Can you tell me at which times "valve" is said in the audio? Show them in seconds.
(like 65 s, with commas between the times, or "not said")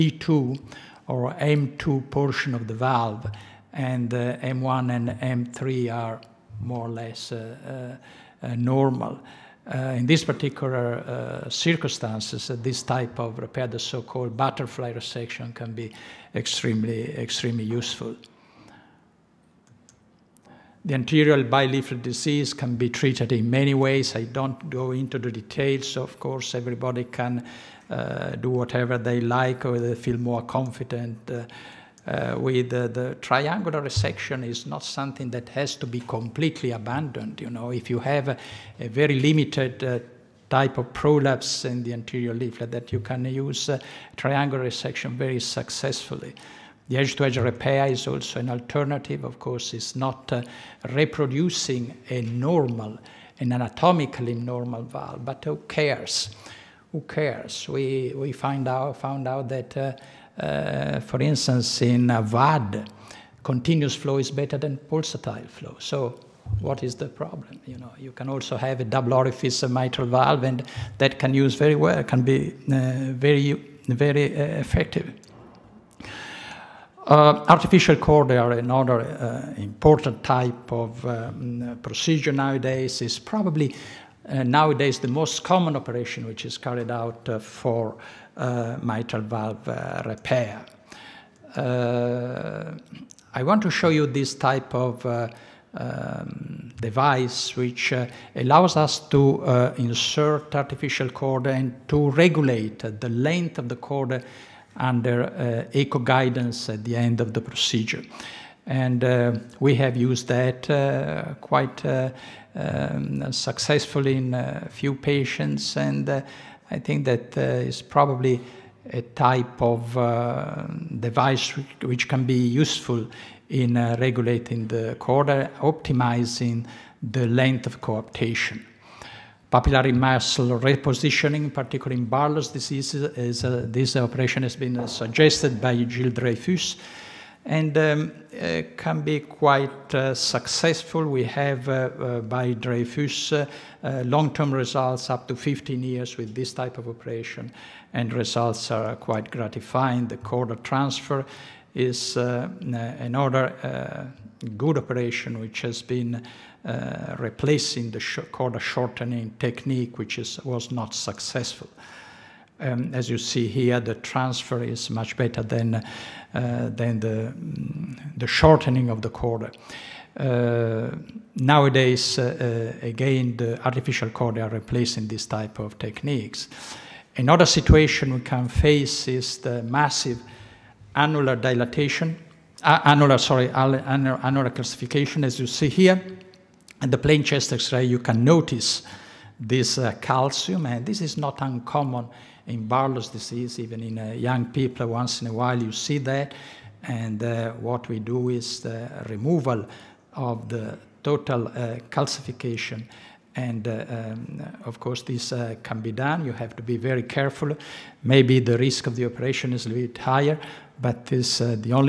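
2 s, 54 s, 70 s, 89 s.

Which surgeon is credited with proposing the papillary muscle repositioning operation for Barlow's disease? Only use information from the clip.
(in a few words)
Gilles Dreyfus.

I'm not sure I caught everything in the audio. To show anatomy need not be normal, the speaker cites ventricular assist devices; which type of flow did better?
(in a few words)
Continuous flow.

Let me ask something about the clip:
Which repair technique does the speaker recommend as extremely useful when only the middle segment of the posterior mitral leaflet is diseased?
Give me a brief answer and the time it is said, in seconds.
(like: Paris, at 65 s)
Butterfly resection, at 14 s.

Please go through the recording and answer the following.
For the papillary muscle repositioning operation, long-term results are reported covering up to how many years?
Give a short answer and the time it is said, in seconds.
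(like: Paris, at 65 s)
15 years, at 145 s.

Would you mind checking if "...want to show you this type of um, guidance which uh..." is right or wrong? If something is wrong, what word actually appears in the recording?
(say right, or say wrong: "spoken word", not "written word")
wrong: "device", not "guidance".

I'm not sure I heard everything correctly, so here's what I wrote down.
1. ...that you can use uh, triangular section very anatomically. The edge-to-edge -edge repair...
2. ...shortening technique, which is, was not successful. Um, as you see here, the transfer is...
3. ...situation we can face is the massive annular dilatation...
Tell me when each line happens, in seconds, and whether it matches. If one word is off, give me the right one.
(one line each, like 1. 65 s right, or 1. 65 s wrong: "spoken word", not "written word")
1. 42 s wrong: "successfully", not "anatomically"
2. 158 s right
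3. 177 s right.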